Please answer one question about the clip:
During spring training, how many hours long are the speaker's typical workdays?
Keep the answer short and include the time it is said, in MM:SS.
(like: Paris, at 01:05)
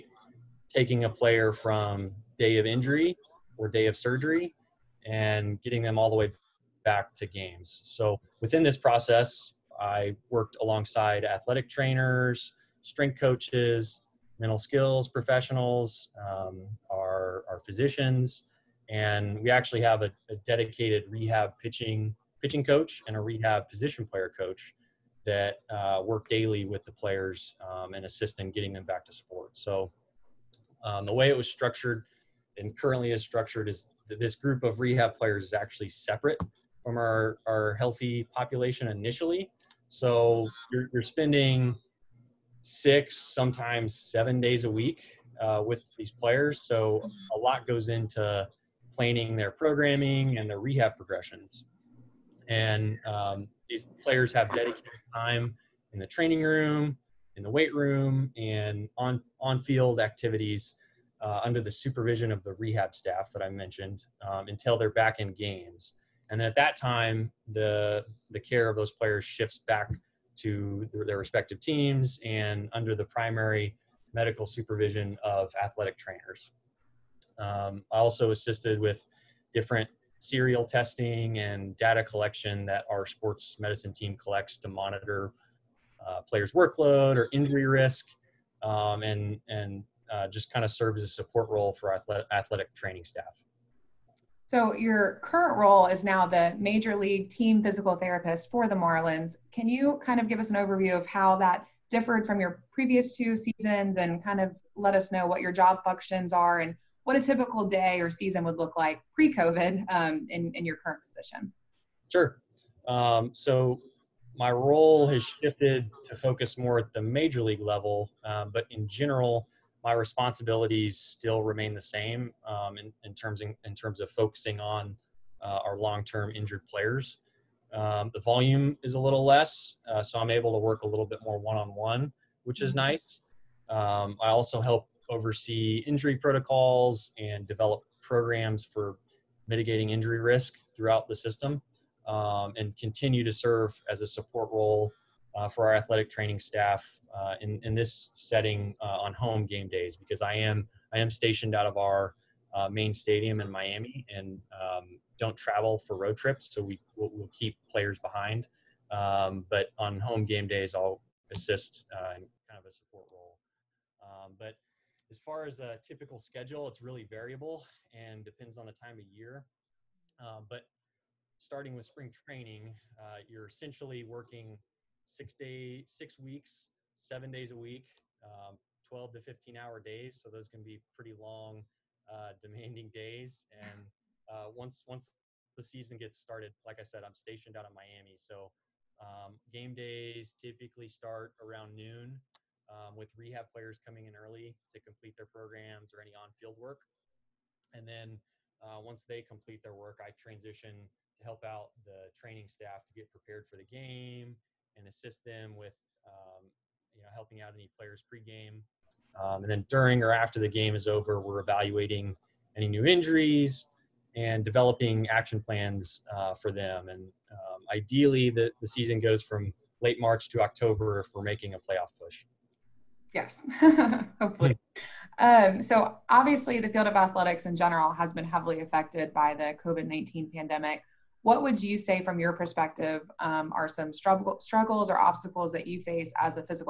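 12 to 15 hours, at 02:58.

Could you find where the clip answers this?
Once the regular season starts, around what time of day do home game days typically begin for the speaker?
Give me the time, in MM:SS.
03:11.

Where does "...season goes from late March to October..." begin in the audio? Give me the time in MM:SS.
03:38.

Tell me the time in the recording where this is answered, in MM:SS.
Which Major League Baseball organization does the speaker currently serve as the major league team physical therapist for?
01:38.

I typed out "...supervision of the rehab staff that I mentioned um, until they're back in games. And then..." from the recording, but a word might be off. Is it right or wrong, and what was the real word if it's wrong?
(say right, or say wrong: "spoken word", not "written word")
right.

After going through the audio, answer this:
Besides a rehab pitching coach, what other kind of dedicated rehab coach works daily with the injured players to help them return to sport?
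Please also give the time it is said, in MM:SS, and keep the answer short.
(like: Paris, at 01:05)
Rehab position player coach, at 00:23.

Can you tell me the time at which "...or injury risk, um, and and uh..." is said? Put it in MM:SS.
01:27.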